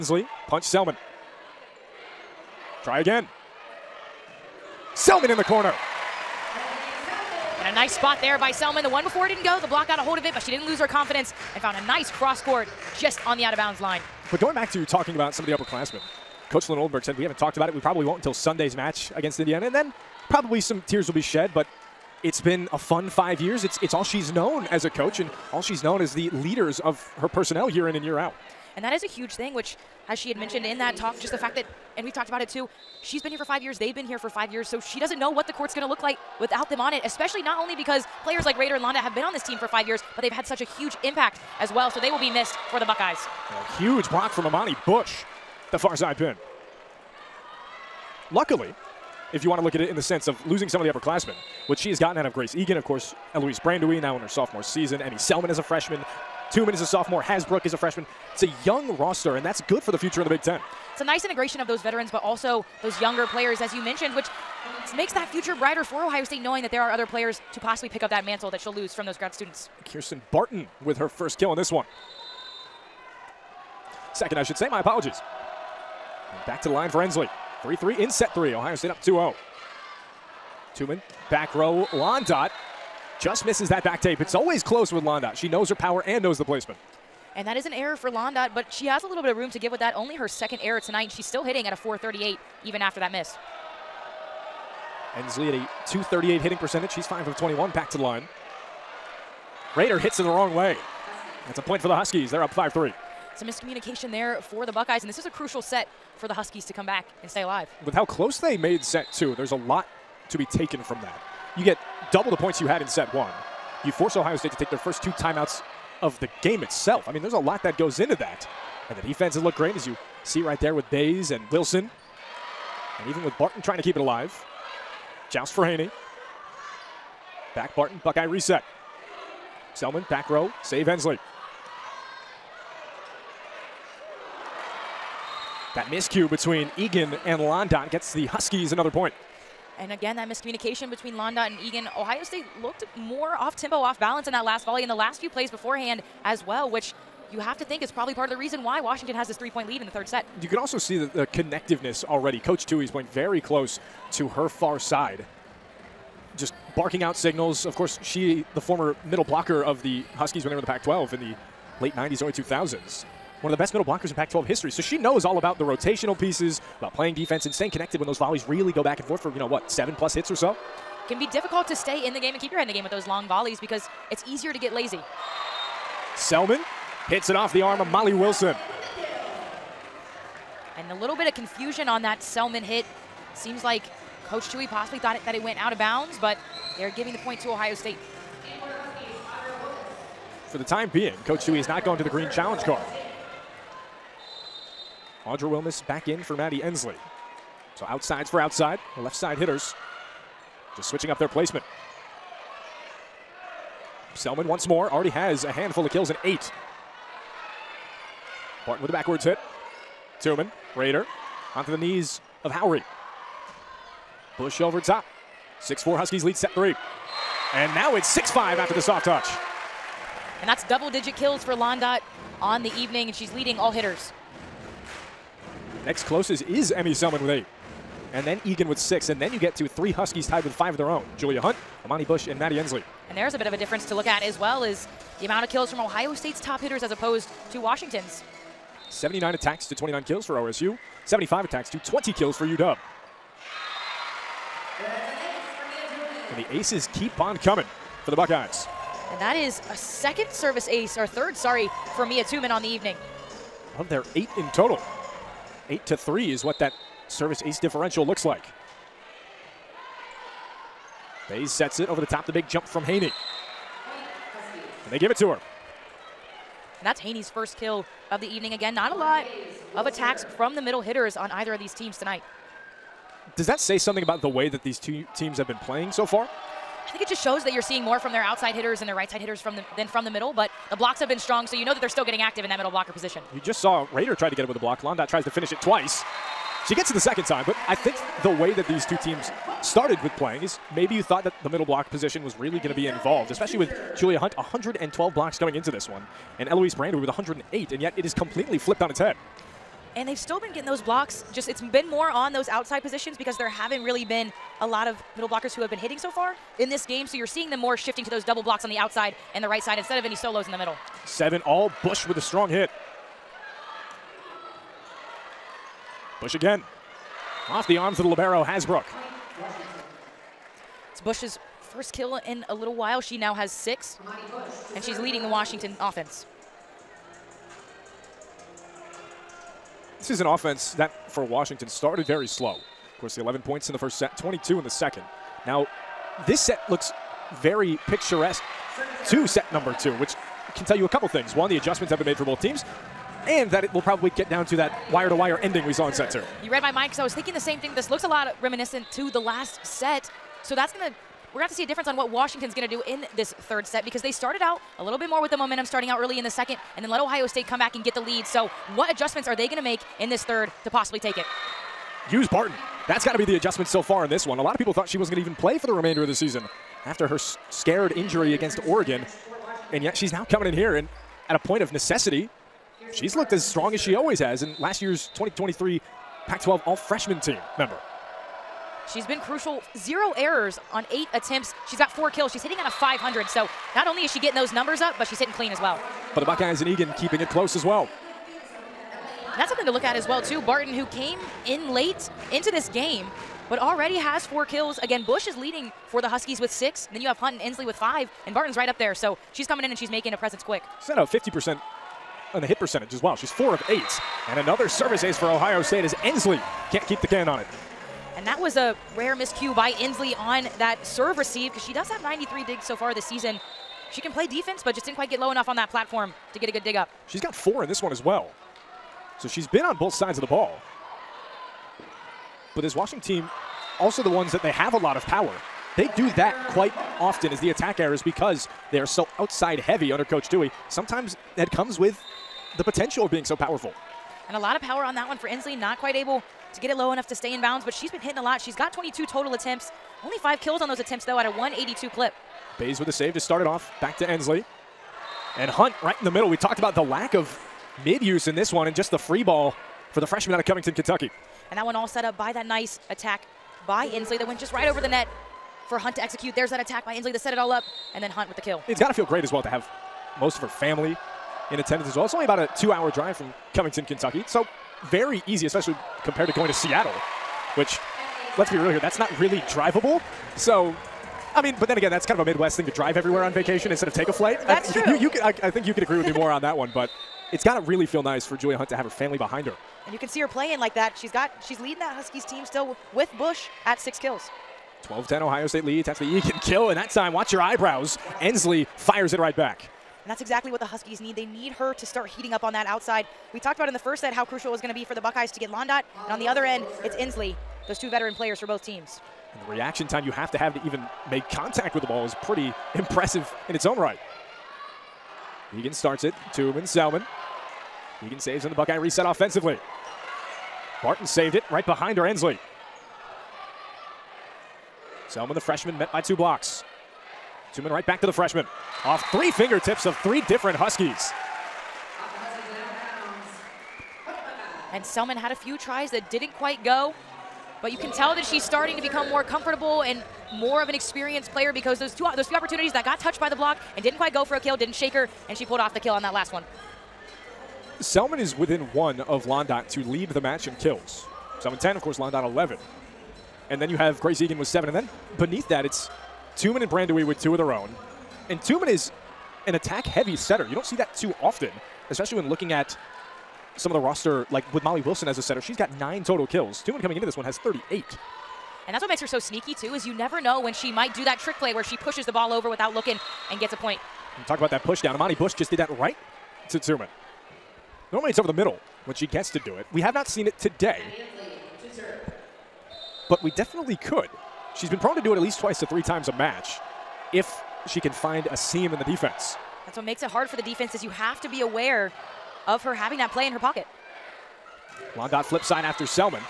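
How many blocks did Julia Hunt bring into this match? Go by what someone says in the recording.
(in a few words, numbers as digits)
112.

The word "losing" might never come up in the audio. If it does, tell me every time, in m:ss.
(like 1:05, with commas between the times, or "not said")
0:50.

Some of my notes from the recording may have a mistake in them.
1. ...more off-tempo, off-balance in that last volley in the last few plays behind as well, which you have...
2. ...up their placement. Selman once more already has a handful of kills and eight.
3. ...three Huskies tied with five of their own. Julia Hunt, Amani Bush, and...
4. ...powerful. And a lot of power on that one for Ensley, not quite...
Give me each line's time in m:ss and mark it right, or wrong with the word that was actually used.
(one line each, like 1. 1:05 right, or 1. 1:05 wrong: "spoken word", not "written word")
1. 2:22 wrong: "beforehand", not "behind"
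2. 3:21 right
3. 3:49 right
4. 7:13 right.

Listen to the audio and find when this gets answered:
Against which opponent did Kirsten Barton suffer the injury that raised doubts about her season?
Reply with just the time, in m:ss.
6:08.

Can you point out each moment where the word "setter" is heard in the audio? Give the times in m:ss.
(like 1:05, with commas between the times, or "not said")
9:10, 9:15.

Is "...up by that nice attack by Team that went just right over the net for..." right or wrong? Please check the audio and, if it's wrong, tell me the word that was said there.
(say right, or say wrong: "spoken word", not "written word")
wrong: "Ensley", not "Team".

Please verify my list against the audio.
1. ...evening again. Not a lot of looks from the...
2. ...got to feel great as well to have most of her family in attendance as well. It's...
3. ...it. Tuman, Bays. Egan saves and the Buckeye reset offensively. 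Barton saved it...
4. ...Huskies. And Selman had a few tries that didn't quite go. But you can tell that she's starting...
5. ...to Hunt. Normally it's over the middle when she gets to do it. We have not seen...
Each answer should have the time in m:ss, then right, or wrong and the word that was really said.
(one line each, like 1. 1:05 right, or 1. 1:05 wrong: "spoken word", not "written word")
1. 4:28 wrong: "attacks", not "looks"
2. 7:38 right
3. 8:26 wrong: "Selman", not "Bays"
4. 8:40 right
5. 9:26 wrong: "Tuman", not "Hunt".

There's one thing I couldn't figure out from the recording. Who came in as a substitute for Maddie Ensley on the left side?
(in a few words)
Audra Wilmes.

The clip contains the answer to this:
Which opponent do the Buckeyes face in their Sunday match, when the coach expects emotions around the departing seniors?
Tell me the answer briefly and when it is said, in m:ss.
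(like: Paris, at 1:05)
Indiana, at 0:19.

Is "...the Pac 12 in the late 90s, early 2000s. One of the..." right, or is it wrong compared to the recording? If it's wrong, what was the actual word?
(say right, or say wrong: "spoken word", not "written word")
right.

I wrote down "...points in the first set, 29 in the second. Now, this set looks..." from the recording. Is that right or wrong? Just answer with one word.
wrong.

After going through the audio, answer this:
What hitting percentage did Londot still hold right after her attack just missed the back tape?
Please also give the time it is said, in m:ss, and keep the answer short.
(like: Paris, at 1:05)
.438, at 1:31.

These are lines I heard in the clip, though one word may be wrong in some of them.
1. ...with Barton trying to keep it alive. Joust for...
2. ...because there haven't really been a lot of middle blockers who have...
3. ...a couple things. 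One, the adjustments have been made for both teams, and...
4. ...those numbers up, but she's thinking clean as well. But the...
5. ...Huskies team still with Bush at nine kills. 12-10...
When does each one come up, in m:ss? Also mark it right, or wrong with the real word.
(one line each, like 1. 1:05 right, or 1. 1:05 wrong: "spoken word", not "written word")
1. 2:03 right
2. 5:03 right
3. 5:40 right
4. 6:24 wrong: "hitting", not "thinking"
5. 8:01 wrong: "six", not "nine".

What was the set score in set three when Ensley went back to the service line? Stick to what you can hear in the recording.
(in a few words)
3-3.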